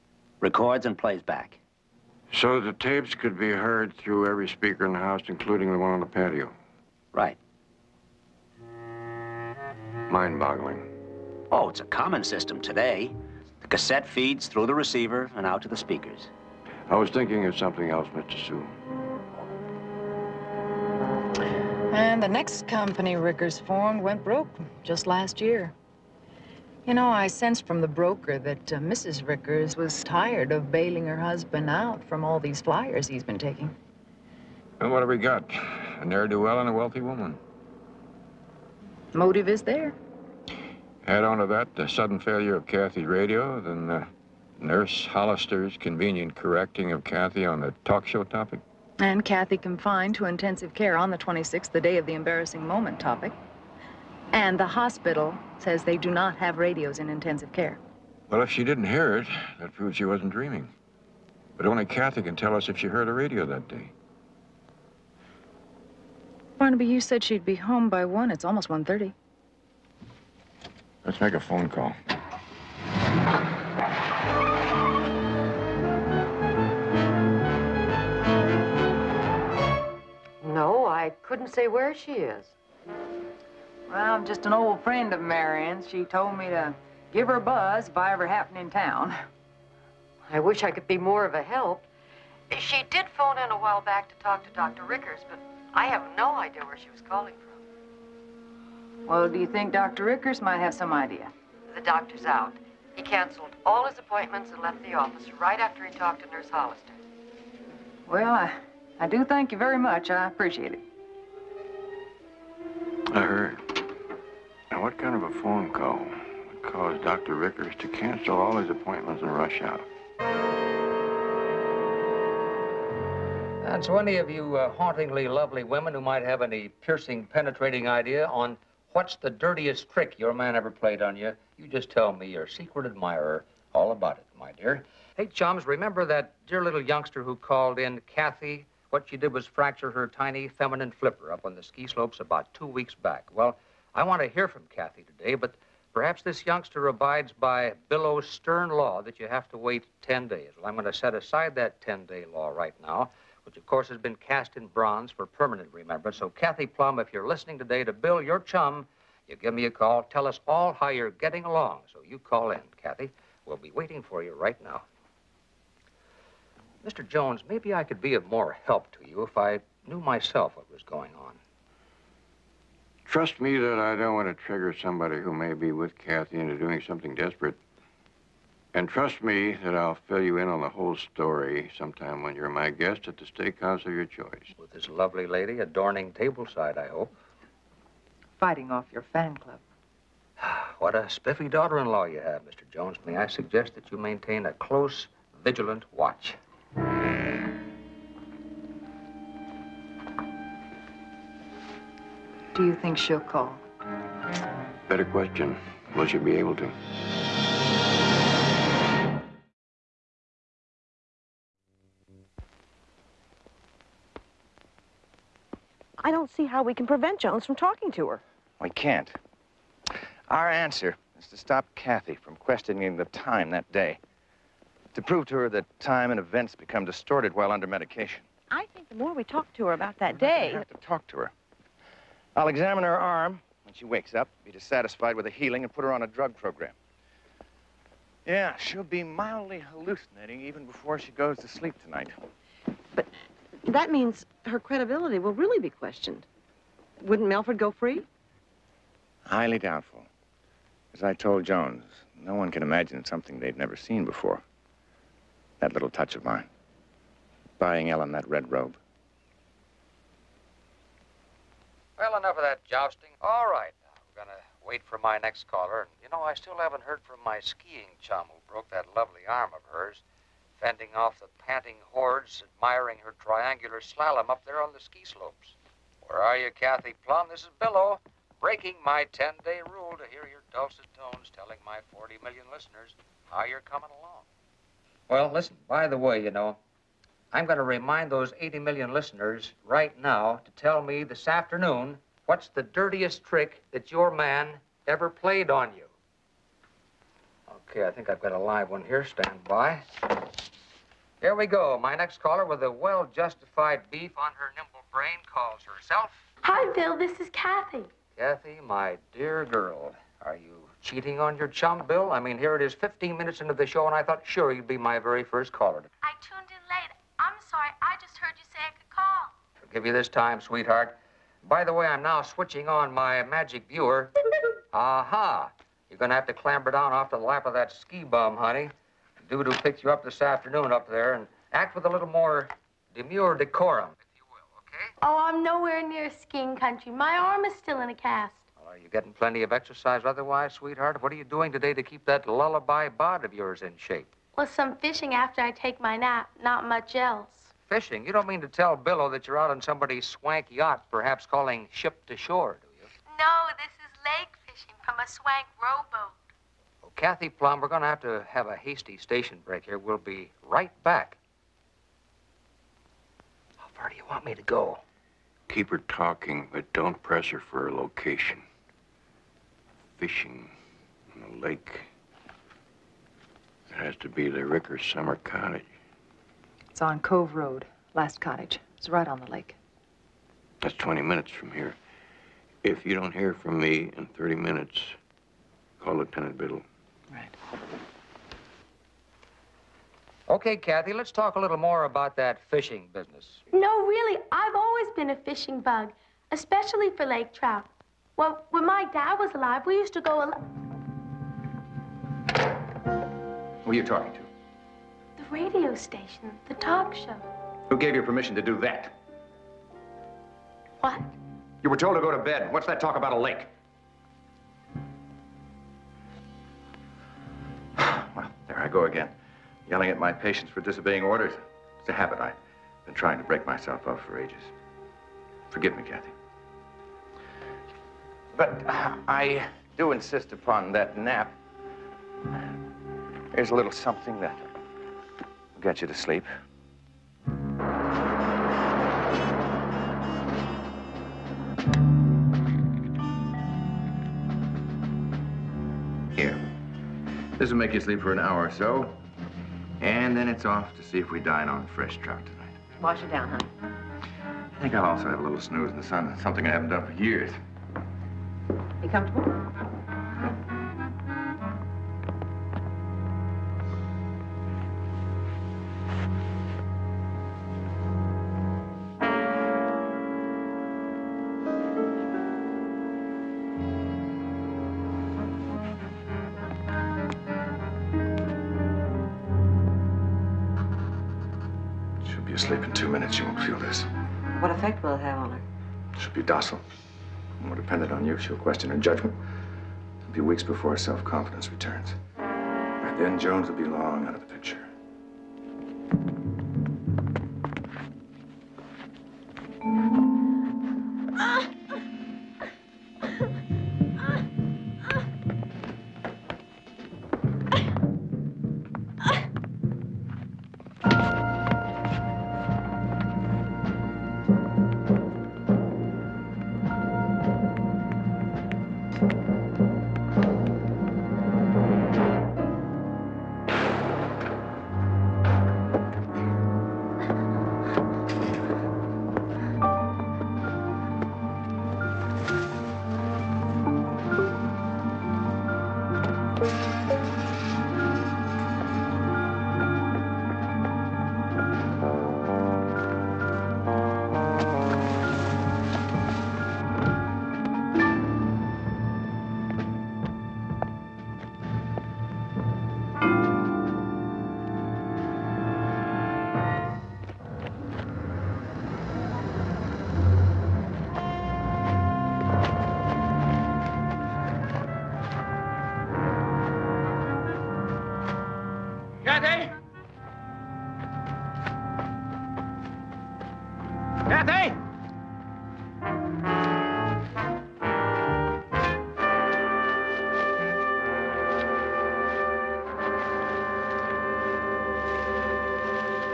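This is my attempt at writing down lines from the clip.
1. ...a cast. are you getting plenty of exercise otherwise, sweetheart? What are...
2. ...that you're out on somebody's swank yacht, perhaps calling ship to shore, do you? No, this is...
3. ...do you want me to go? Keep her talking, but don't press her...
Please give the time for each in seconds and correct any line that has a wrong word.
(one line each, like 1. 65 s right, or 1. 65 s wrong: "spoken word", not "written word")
1. 337 s right
2. 349 s right
3. 363 s right.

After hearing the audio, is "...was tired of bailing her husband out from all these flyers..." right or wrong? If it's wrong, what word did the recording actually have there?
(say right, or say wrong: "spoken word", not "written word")
right.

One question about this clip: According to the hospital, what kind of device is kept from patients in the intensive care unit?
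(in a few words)
Radios.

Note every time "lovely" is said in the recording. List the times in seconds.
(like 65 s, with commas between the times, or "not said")
125 s, 184 s, 268 s.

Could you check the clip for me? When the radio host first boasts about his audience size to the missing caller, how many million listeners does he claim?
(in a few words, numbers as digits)
40 million.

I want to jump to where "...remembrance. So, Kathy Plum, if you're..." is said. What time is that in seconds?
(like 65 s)
155 s.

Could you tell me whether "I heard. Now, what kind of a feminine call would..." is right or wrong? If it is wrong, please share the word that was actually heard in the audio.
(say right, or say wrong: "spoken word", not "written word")
wrong: "phone", not "feminine".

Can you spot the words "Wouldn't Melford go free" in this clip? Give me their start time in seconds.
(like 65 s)
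247 s.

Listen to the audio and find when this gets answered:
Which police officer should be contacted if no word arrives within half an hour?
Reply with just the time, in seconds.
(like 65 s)
385 s.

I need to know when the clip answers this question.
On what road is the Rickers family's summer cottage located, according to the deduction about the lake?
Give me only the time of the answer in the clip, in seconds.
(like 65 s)
376 s.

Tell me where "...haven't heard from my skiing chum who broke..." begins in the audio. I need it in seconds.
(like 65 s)
266 s.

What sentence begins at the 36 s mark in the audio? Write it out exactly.
A ne'er-do-well and a wealthy woman.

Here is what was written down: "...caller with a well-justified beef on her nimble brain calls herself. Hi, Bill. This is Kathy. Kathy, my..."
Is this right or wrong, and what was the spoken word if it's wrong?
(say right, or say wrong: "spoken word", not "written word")
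right.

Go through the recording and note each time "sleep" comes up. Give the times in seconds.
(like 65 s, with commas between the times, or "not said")
241 s, 435 s, 447 s.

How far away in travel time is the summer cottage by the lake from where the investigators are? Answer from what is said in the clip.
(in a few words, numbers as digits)
20 minutes.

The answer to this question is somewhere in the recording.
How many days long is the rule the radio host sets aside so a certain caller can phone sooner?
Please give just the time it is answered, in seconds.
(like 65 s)
151 s.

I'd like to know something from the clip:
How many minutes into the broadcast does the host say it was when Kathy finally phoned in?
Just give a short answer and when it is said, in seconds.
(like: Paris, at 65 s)
15, at 312 s.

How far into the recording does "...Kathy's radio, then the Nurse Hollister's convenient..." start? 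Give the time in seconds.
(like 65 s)
42 s.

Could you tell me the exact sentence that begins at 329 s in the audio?
Doodoo picked you up this afternoon up there and act with a little more demure decorum, if you will, okay?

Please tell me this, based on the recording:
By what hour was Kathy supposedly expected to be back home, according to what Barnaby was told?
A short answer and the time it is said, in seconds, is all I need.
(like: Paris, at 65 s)
1, at 68 s.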